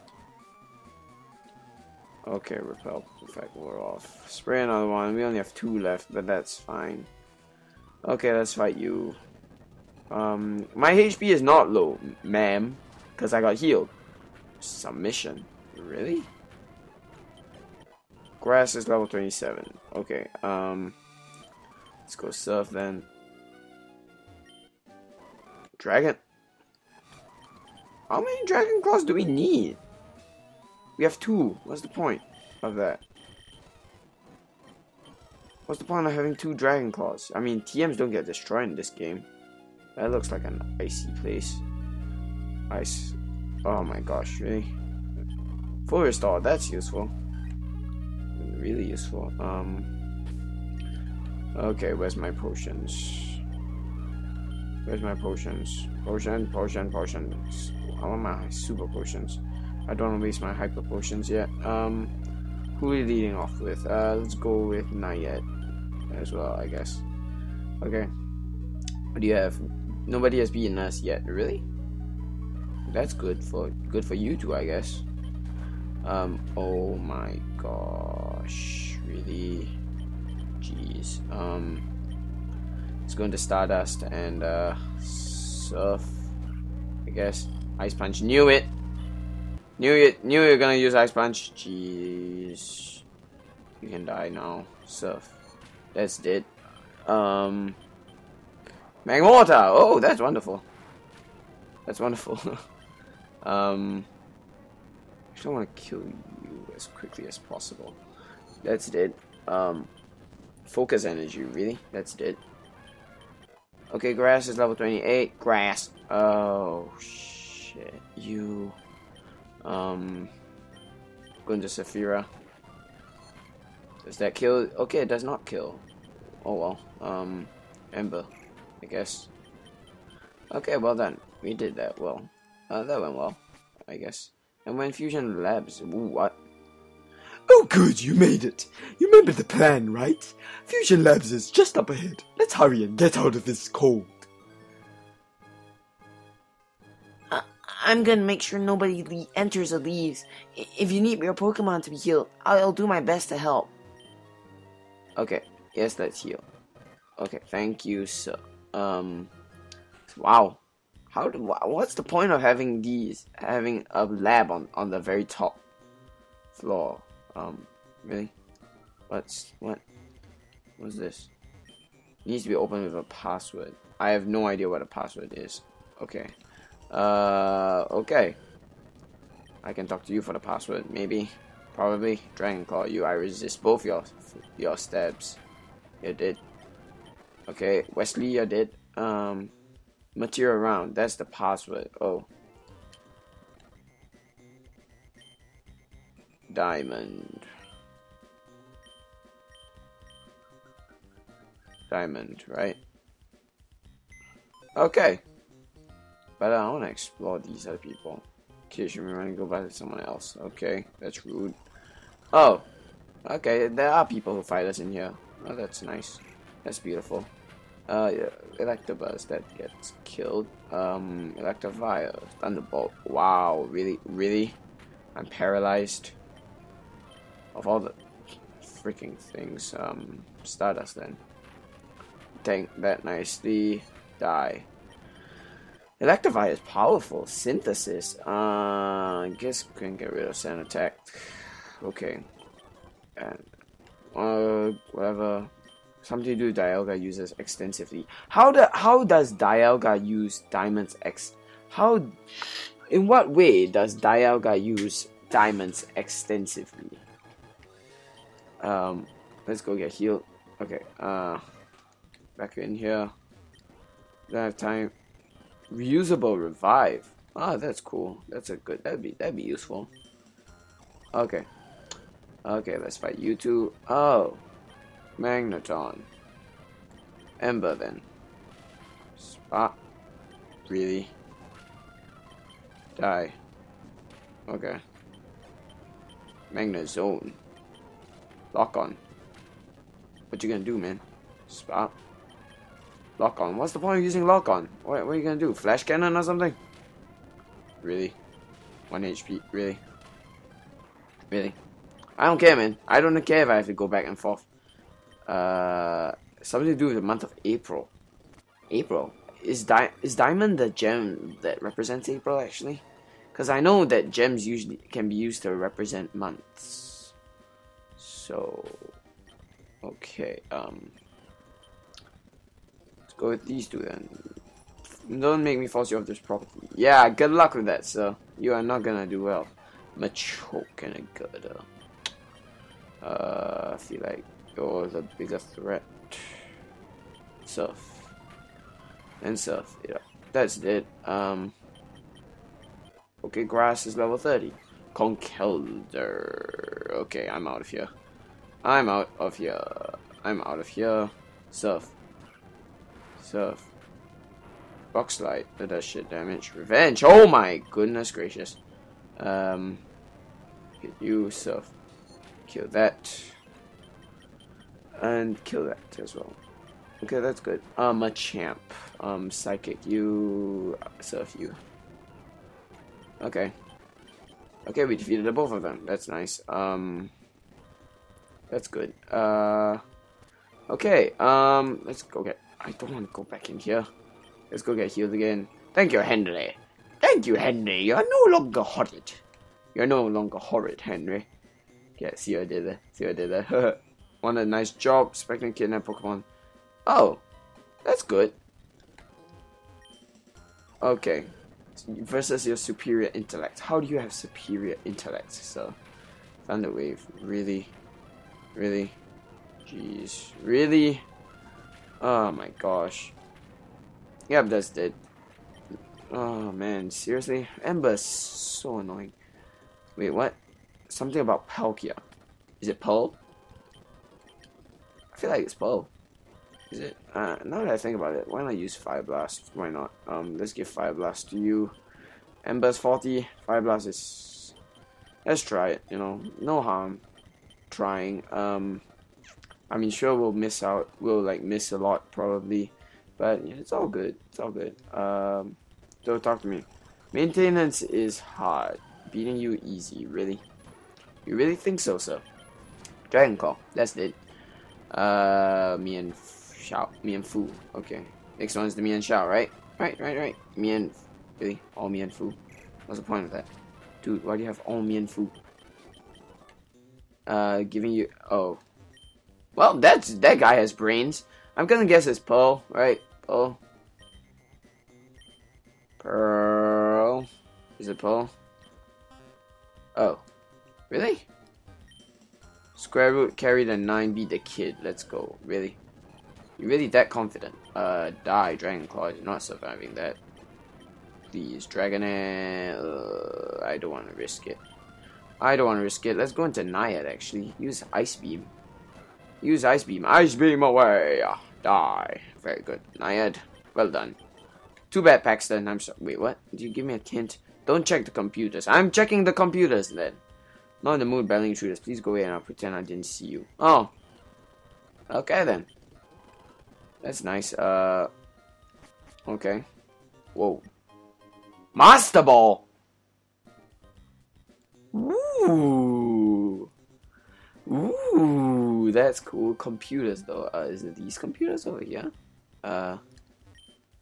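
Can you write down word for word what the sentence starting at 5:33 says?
Uh, see, like, you're the biggest threat.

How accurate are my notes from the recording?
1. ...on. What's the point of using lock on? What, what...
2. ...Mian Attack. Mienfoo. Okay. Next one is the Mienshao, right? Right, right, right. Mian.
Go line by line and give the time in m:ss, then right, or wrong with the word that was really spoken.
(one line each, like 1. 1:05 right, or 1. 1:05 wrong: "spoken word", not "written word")
1. 4:53 right
2. 7:35 wrong: "Shao", not "Attack".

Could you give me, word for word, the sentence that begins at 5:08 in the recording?
April is di is diamond the gem that represents April actually?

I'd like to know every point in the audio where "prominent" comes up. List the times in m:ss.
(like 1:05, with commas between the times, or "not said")
not said.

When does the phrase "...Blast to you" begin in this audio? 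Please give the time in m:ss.
7:10.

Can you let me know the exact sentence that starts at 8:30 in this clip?
Not in the mood, battling shooters.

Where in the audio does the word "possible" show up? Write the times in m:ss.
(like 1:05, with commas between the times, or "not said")
1:47.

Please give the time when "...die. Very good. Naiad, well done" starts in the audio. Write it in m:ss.
8:21.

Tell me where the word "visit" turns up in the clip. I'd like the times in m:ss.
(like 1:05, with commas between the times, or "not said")
not said.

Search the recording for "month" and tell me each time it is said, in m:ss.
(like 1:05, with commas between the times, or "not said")
5:07, 5:16.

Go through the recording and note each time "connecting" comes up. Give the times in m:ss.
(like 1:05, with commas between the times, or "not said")
not said.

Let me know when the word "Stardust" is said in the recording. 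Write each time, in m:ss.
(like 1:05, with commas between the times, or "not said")
1:23, 3:50.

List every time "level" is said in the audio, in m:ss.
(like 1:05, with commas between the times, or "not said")
0:18, 1:54, 5:43.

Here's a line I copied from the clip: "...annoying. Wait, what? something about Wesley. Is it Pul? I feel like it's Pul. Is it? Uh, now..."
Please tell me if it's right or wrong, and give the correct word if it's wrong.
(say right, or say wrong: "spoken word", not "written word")
wrong: "Palkia", not "Wesley".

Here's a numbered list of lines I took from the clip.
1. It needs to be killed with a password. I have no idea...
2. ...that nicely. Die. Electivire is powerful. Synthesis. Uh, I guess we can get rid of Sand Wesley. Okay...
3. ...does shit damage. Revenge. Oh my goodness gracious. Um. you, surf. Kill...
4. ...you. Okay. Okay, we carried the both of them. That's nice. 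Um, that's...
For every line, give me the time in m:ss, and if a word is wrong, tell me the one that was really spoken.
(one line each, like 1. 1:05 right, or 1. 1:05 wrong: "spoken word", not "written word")
1. 2:51 wrong: "opened", not "killed"
2. 3:52 wrong: "Attack", not "Wesley"
3. 5:55 right
4. 6:11 wrong: "defeated", not "carried".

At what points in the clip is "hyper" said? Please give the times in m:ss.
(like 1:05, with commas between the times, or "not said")
1:00.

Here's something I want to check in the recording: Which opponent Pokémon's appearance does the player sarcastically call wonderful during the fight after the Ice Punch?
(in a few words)
Magmortar.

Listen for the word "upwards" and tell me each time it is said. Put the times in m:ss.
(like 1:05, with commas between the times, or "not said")
not said.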